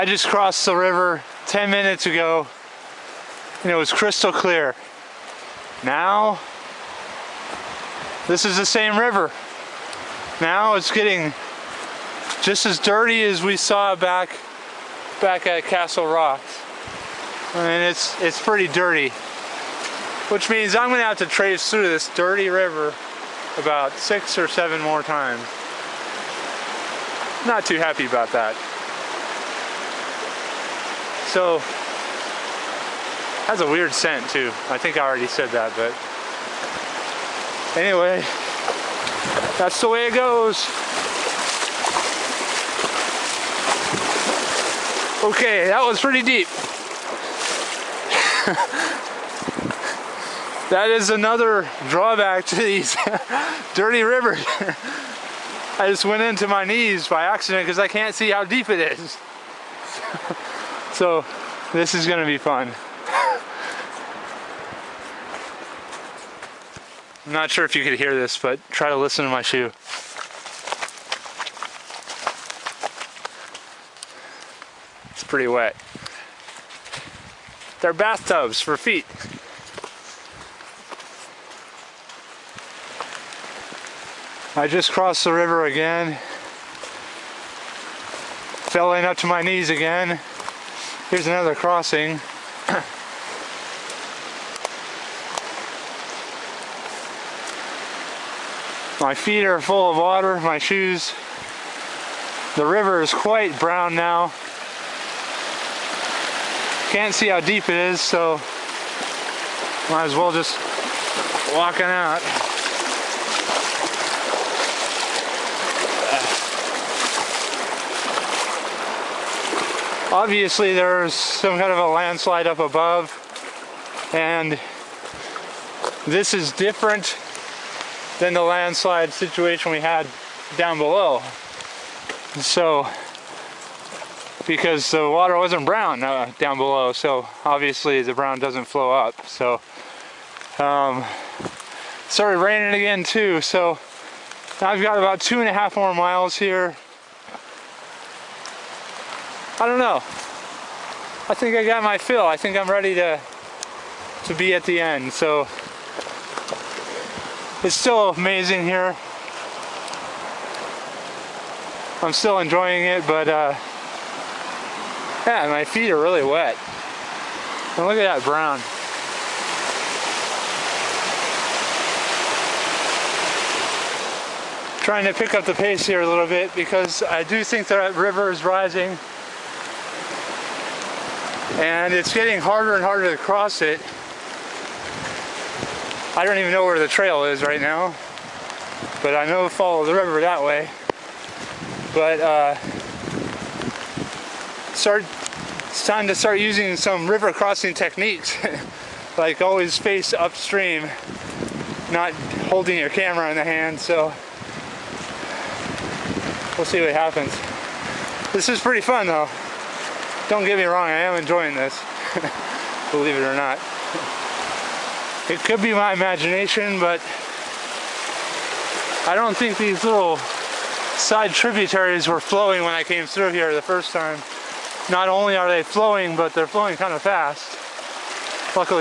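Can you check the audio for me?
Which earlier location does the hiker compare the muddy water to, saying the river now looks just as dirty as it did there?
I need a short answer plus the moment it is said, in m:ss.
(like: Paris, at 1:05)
Castle Rock, at 0:15.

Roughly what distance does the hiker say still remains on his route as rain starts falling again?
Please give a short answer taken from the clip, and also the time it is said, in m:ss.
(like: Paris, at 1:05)
2.5 miles, at 2:25.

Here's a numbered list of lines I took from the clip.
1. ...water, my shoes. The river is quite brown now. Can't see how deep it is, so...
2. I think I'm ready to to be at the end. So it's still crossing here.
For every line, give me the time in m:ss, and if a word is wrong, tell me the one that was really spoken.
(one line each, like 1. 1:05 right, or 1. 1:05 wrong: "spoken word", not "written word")
1. 1:39 right
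2. 2:32 wrong: "amazing", not "crossing".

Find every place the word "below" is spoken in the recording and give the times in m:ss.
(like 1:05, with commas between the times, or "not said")
2:10, 2:16.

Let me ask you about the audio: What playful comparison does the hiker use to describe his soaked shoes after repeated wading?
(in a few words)
bathtubs for feet.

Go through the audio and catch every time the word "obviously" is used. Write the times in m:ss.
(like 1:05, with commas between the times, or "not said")
2:00, 2:17.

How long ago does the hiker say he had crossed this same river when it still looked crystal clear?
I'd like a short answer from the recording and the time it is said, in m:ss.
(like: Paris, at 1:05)
10 minutes, at 0:01.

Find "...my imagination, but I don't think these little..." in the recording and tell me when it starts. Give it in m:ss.
3:35.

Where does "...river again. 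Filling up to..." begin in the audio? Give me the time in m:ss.
1:25.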